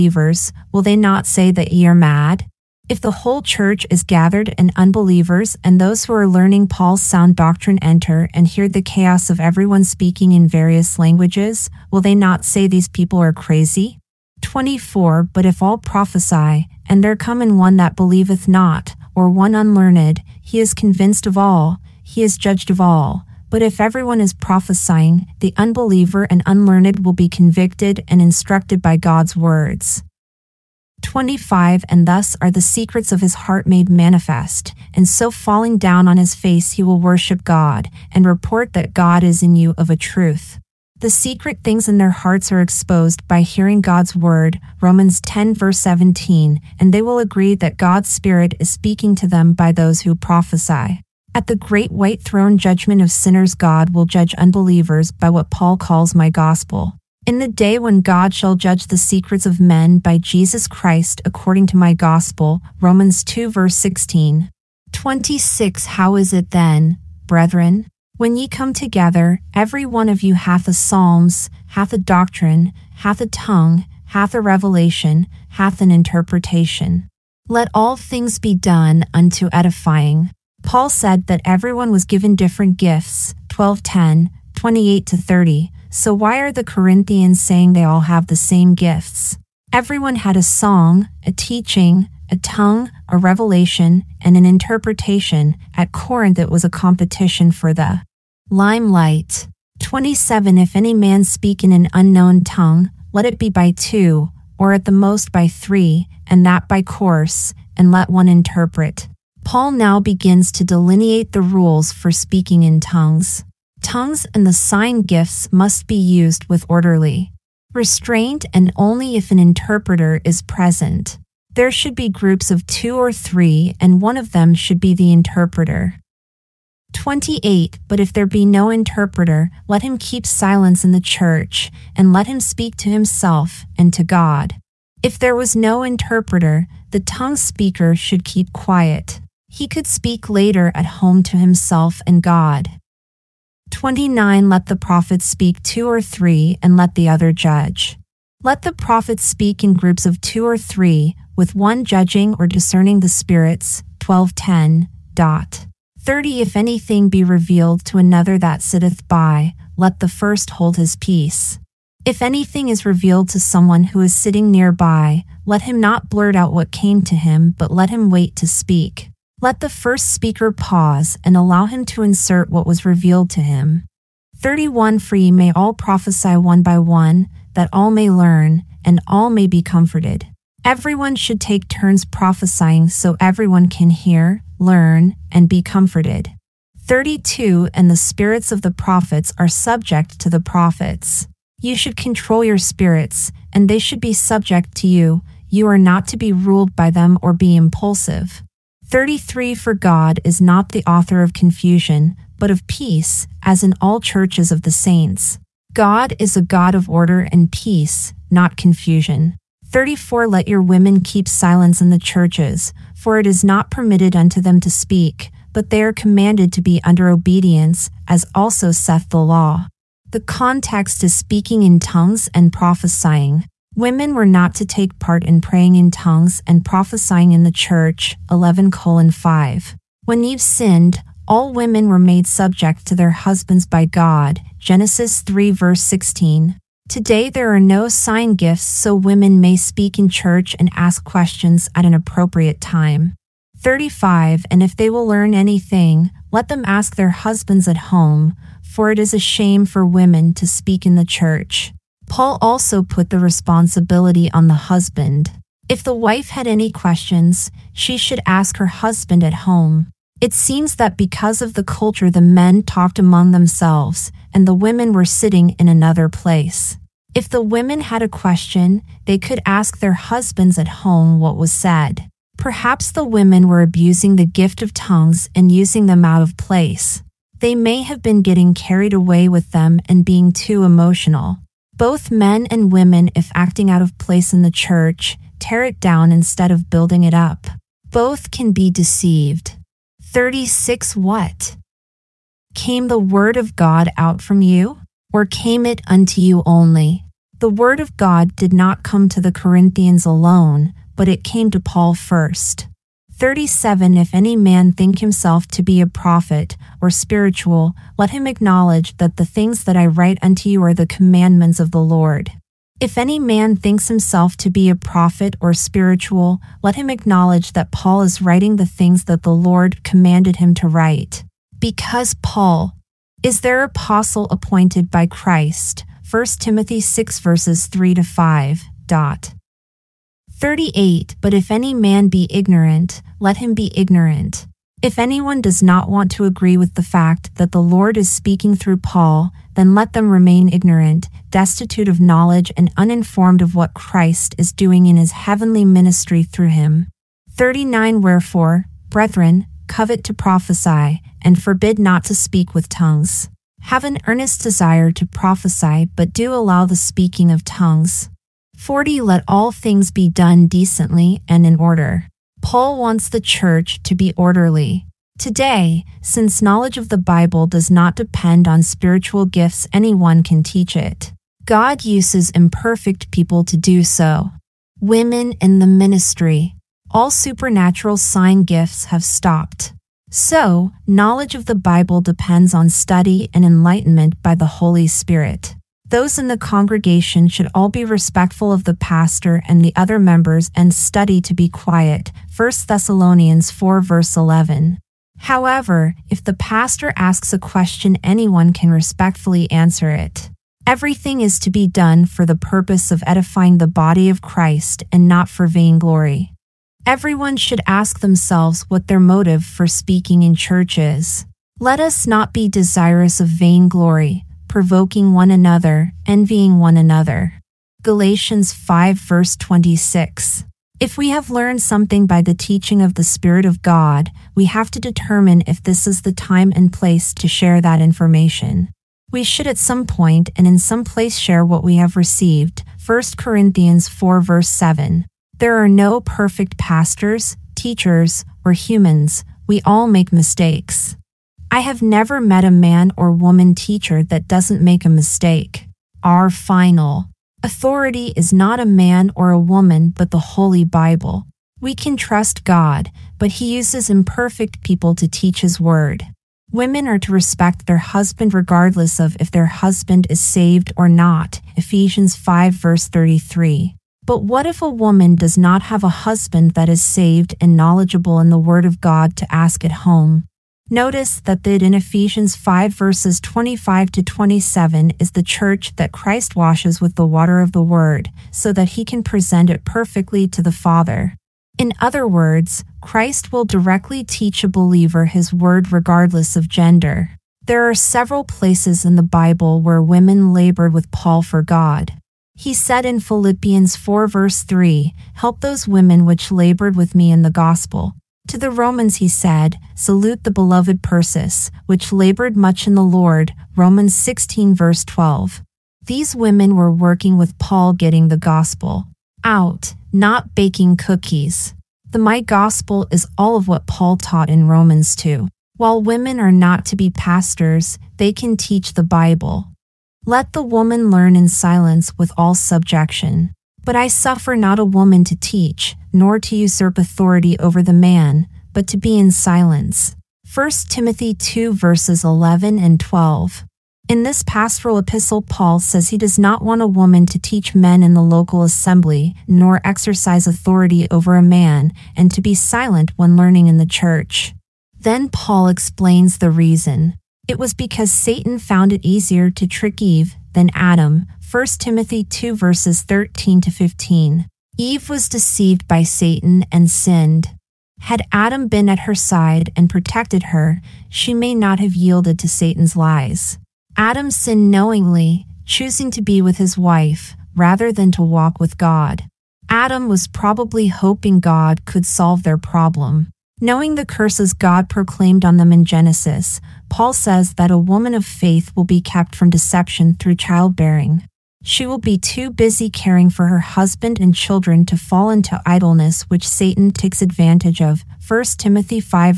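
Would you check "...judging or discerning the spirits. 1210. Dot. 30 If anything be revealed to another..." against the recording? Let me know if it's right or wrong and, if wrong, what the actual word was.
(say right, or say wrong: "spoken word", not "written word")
right.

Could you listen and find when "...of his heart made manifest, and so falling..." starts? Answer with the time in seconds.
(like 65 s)
33 s.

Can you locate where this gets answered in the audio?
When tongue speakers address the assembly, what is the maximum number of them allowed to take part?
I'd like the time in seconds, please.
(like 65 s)
104 s.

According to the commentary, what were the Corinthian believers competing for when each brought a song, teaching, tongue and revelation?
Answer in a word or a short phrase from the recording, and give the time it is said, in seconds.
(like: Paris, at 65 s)
The Limelight, at 97 s.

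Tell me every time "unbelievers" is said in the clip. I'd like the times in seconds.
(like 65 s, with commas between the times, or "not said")
4 s, 25 s, 54 s.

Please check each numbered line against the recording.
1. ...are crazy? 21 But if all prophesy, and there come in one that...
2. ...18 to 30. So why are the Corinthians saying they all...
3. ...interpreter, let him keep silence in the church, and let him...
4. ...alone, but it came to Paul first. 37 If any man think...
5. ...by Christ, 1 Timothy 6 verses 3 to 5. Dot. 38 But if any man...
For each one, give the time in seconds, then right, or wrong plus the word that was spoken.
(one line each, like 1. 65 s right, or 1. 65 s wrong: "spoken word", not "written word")
1. 13 s wrong: "24", not "21"
2. 84 s wrong: "28", not "18"
3. 128 s right
4. 300 s right
5. 324 s right.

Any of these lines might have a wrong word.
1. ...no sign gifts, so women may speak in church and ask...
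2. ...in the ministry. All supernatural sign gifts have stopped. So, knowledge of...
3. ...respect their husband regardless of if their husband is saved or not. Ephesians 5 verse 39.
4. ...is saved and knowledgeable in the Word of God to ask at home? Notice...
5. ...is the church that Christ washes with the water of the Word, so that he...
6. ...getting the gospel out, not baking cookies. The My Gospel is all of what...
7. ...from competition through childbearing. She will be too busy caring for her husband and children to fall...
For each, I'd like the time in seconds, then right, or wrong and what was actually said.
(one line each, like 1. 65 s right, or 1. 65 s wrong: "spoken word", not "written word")
1. 237 s right
2. 375 s right
3. 457 s wrong: "33", not "39"
4. 466 s right
5. 474 s right
6. 507 s right
7. 579 s wrong: "deception", not "competition".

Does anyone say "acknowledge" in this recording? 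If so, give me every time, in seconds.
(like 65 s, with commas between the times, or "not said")
308 s, 316 s.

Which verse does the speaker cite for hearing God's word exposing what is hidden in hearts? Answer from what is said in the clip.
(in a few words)
Romans 10:17.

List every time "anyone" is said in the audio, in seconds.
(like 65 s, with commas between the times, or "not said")
334 s, 369 s, 398 s.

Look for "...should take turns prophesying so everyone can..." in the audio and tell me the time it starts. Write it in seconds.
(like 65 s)
181 s.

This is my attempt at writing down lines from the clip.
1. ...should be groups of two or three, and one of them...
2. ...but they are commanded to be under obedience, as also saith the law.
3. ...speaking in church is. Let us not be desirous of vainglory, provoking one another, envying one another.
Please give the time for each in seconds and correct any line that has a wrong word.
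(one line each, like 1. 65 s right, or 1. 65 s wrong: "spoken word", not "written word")
1. 121 s right
2. 215 s right
3. 409 s right.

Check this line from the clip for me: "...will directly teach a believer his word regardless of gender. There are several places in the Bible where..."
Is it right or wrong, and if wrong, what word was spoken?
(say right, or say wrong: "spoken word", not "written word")
right.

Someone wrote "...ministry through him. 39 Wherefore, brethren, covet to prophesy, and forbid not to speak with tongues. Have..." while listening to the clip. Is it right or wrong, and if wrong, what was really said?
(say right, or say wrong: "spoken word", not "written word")
right.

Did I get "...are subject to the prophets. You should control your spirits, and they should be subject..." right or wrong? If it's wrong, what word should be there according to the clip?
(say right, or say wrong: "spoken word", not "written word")
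right.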